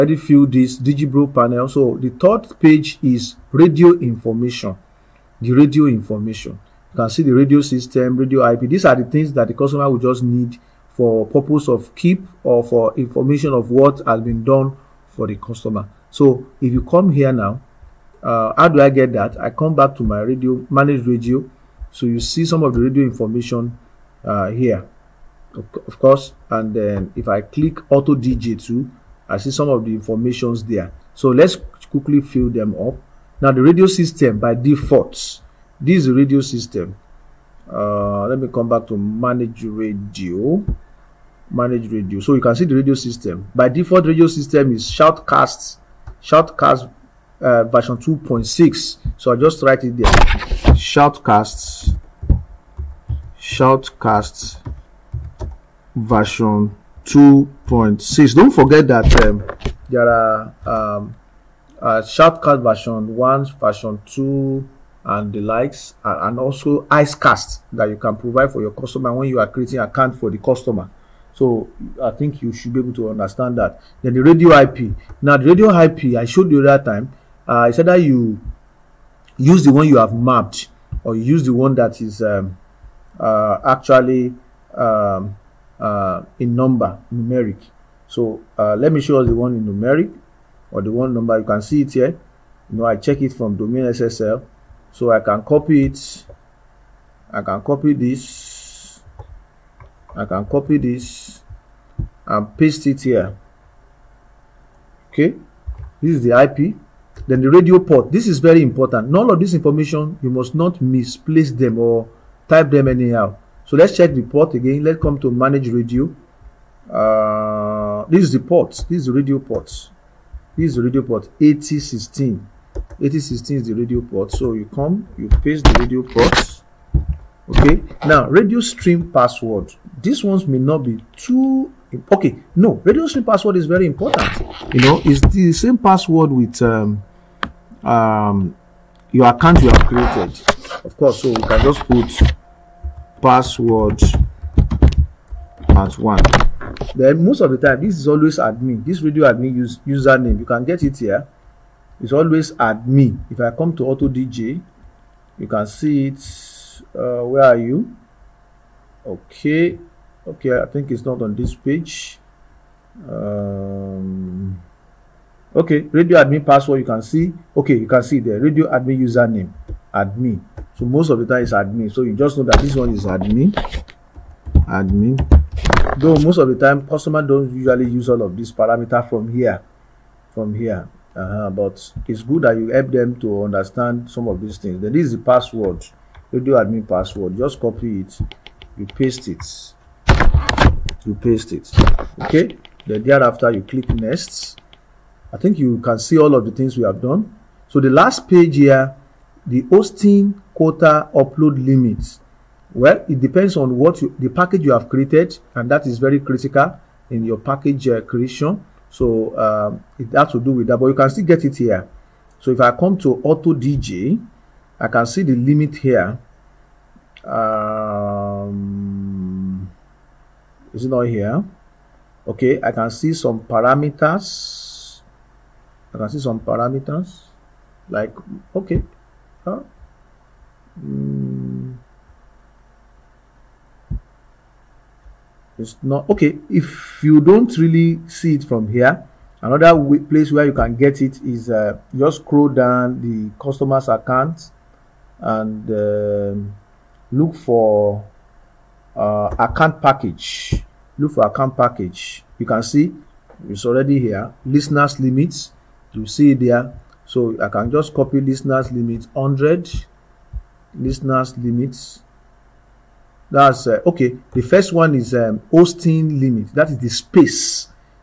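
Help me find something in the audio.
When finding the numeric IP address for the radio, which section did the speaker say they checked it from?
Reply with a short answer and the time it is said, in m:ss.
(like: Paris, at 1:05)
domain SSL, at 1:33.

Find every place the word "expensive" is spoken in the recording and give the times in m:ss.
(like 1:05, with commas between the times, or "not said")
not said.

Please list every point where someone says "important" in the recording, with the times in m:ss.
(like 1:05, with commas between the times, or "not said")
1:48, 2:13.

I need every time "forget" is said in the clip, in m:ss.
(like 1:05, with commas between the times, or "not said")
0:58.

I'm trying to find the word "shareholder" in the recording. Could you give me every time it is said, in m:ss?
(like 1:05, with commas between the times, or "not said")
not said.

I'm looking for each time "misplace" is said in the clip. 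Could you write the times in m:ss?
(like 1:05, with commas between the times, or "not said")
1:50.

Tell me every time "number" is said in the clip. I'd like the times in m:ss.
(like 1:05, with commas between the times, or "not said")
1:26, 1:31.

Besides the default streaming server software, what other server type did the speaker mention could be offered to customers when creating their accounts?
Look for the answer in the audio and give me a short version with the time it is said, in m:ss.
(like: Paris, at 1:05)
Icecast, at 1:06.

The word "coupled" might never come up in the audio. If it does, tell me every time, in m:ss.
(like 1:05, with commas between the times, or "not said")
not said.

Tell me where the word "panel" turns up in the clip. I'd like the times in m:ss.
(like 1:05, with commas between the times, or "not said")
0:01.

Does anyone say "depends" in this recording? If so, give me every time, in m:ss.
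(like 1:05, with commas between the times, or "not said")
3:23.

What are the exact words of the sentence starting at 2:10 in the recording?
These ones may not be too okay.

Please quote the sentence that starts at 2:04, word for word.
So you come, you paste the radio port.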